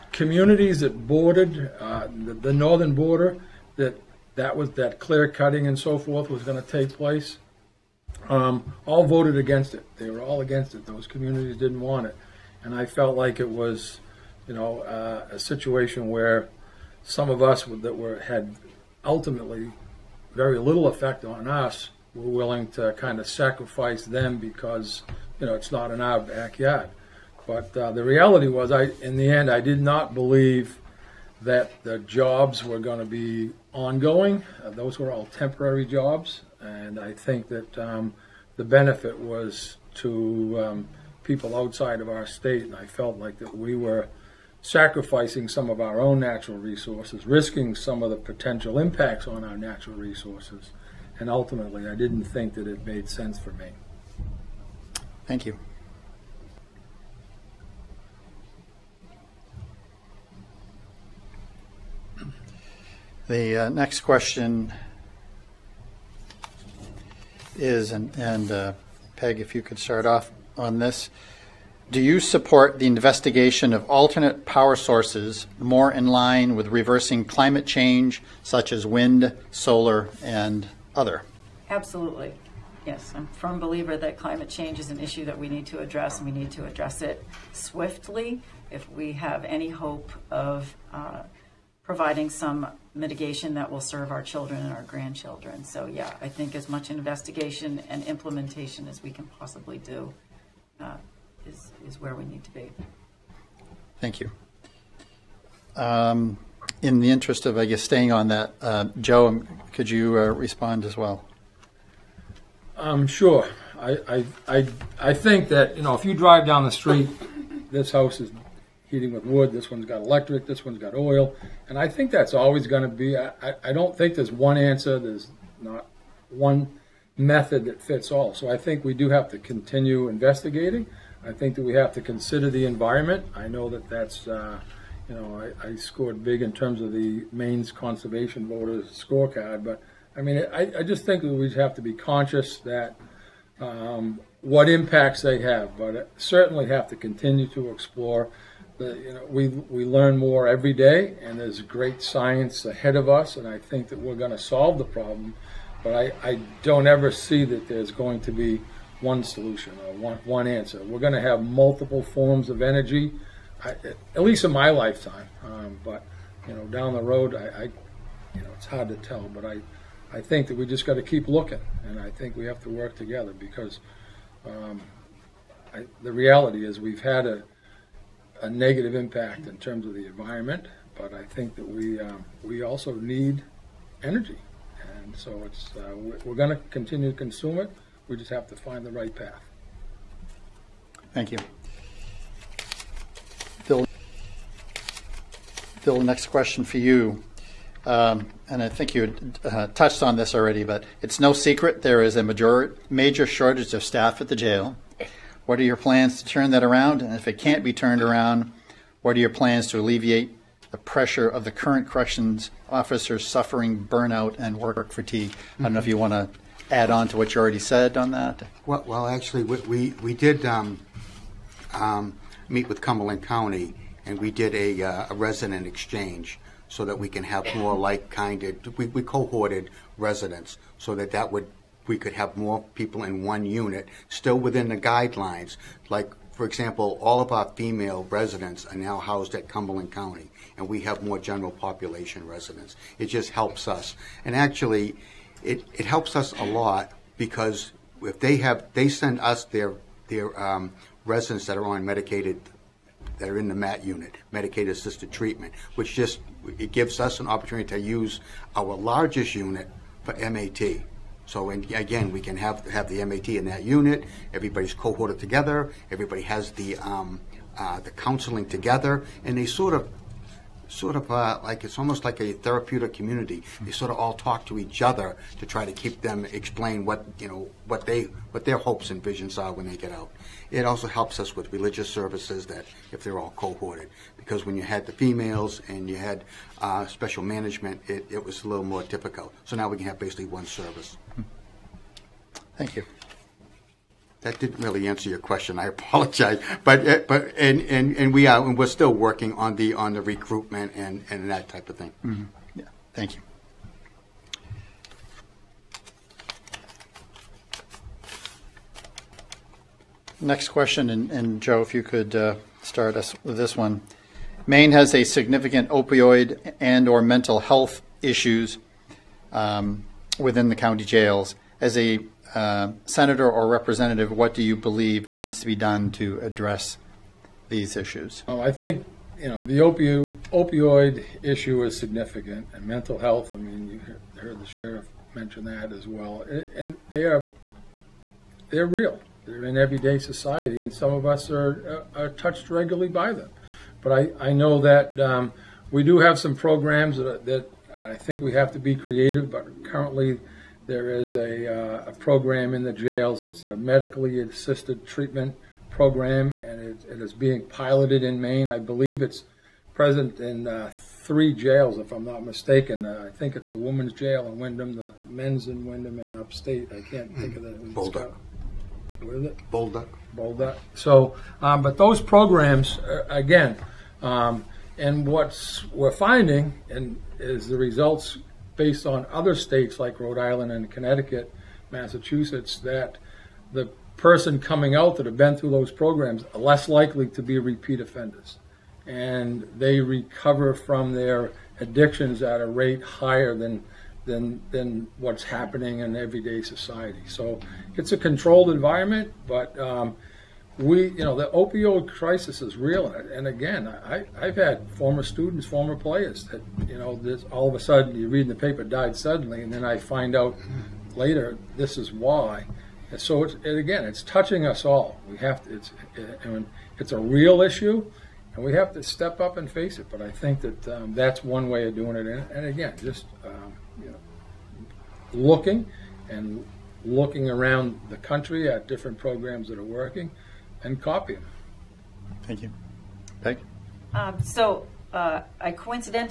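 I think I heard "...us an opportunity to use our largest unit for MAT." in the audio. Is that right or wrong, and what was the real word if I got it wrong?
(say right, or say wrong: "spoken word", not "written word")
right.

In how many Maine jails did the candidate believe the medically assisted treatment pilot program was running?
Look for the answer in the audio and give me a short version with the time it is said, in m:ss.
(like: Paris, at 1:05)
3, at 6:00.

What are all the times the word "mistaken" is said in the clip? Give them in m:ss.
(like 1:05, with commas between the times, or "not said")
6:02.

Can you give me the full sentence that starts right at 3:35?
I don't know if you want to add on to what you already said on that.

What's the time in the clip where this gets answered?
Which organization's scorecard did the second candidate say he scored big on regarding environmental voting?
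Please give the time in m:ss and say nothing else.
2:17.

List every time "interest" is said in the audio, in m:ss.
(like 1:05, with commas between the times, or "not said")
1:47.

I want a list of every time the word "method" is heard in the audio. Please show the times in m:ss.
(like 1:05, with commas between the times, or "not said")
2:07.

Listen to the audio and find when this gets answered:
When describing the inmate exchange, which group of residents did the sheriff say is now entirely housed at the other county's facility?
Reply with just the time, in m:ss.
3:57.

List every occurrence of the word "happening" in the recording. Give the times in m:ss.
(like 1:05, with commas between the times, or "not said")
6:35.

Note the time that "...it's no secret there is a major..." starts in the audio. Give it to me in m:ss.
3:21.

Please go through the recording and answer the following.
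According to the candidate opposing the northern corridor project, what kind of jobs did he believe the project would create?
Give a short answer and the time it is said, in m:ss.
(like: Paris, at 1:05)
Temporary jobs, at 0:35.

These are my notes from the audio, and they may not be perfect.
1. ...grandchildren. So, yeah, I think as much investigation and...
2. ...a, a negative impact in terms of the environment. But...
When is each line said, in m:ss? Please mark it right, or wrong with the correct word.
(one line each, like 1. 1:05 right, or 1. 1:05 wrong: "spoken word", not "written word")
1. 1:34 right
2. 2:57 right.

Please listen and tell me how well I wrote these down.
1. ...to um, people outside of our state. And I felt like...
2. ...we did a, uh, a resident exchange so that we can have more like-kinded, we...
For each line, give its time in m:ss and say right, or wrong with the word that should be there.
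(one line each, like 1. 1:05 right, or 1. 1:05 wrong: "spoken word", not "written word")
1. 0:39 right
2. 3:44 right.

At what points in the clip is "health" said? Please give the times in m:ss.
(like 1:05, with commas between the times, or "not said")
5:17, 5:32.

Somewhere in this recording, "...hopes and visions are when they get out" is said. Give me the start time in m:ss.
4:38.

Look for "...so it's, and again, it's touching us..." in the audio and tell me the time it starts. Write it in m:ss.
6:52.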